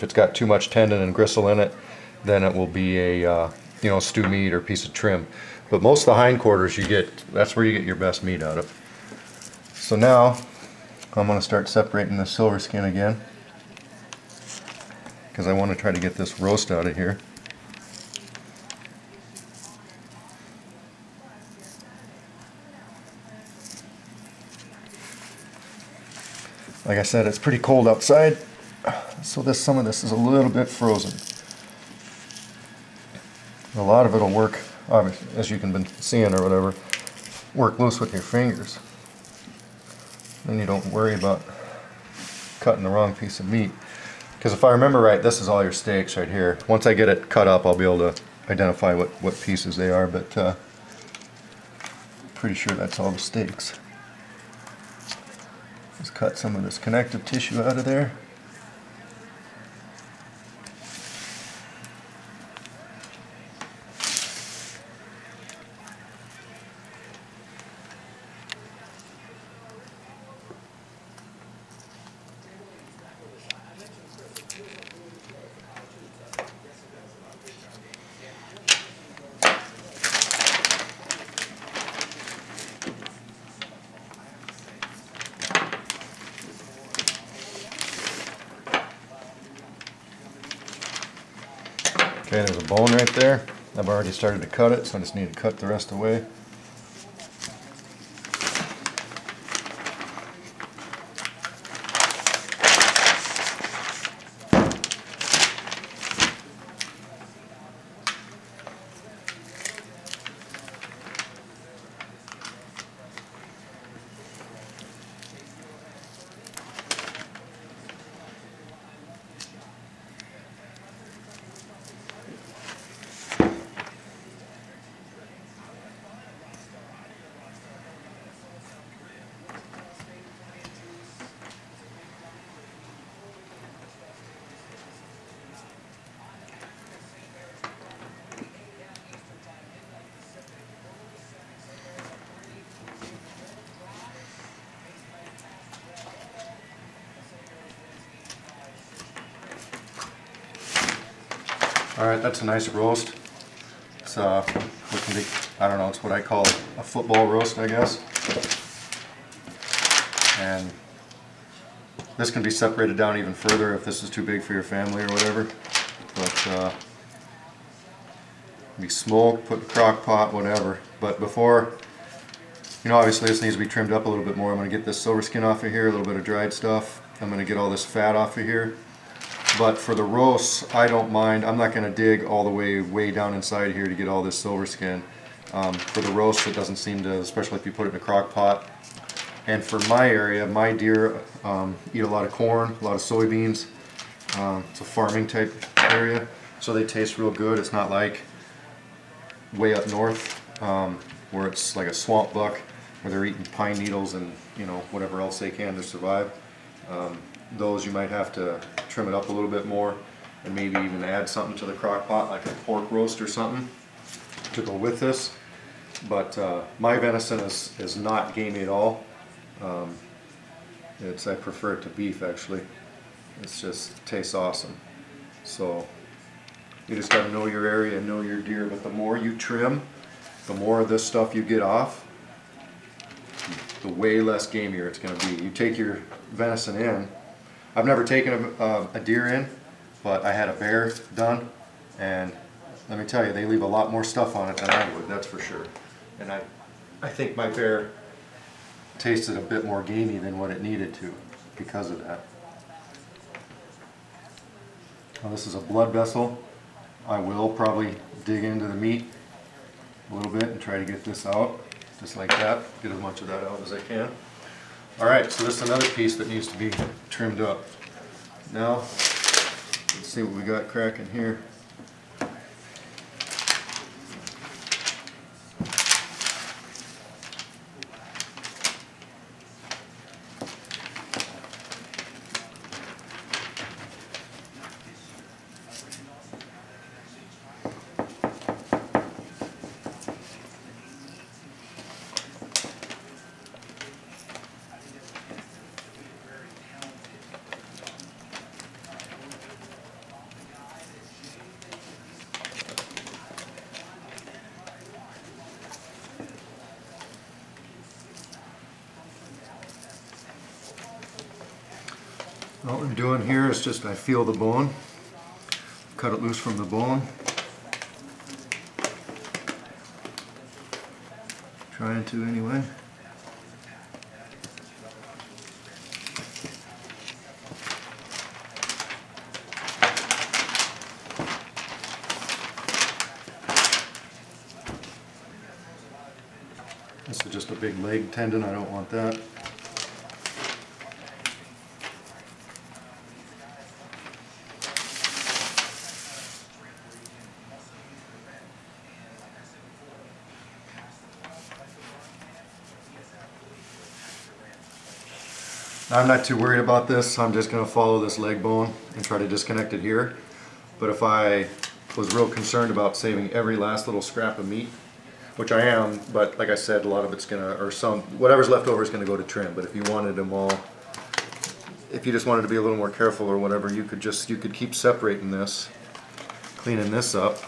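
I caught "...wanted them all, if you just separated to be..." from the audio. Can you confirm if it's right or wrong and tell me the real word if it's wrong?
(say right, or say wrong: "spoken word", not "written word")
wrong: "wanted", not "separated".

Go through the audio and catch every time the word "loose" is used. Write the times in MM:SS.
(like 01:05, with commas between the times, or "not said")
00:37, 05:16.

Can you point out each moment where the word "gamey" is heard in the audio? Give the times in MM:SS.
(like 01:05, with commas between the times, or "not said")
03:38, 04:09.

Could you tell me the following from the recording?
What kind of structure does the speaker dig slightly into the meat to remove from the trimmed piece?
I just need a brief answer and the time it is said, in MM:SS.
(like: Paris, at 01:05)
blood vessel, at 04:15.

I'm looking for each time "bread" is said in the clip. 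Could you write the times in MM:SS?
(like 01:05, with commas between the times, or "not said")
not said.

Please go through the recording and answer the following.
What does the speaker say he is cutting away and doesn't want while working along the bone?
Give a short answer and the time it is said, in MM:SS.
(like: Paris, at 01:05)
leg tendon, at 05:37.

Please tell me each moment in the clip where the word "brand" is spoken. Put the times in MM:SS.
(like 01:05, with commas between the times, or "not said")
not said.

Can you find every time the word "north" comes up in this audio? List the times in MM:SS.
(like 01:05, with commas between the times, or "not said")
03:19.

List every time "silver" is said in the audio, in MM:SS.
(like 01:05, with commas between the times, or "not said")
00:12, 02:54, 03:04.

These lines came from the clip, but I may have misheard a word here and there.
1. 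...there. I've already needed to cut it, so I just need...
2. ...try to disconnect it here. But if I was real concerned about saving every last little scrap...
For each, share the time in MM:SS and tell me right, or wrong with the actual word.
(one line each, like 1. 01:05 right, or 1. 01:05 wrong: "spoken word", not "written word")
1. 01:33 wrong: "started", not "needed"
2. 05:59 right.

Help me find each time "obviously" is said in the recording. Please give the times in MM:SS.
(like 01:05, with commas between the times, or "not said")
00:34, 02:52.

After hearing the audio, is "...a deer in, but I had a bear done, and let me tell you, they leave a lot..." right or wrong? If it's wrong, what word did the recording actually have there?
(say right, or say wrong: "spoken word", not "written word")
right.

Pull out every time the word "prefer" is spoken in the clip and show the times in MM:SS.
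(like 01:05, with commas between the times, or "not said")
03:41.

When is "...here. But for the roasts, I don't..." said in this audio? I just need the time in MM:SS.
02:58.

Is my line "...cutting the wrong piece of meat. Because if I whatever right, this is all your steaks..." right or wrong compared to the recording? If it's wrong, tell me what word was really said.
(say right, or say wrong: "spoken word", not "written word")
wrong: "remember", not "whatever".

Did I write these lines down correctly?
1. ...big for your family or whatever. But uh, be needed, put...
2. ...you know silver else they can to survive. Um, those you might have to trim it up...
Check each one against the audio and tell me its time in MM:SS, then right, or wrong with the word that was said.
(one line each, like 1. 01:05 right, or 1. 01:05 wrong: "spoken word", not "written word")
1. 02:44 wrong: "smoked", not "needed"
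2. 03:24 wrong: "whatever", not "silver".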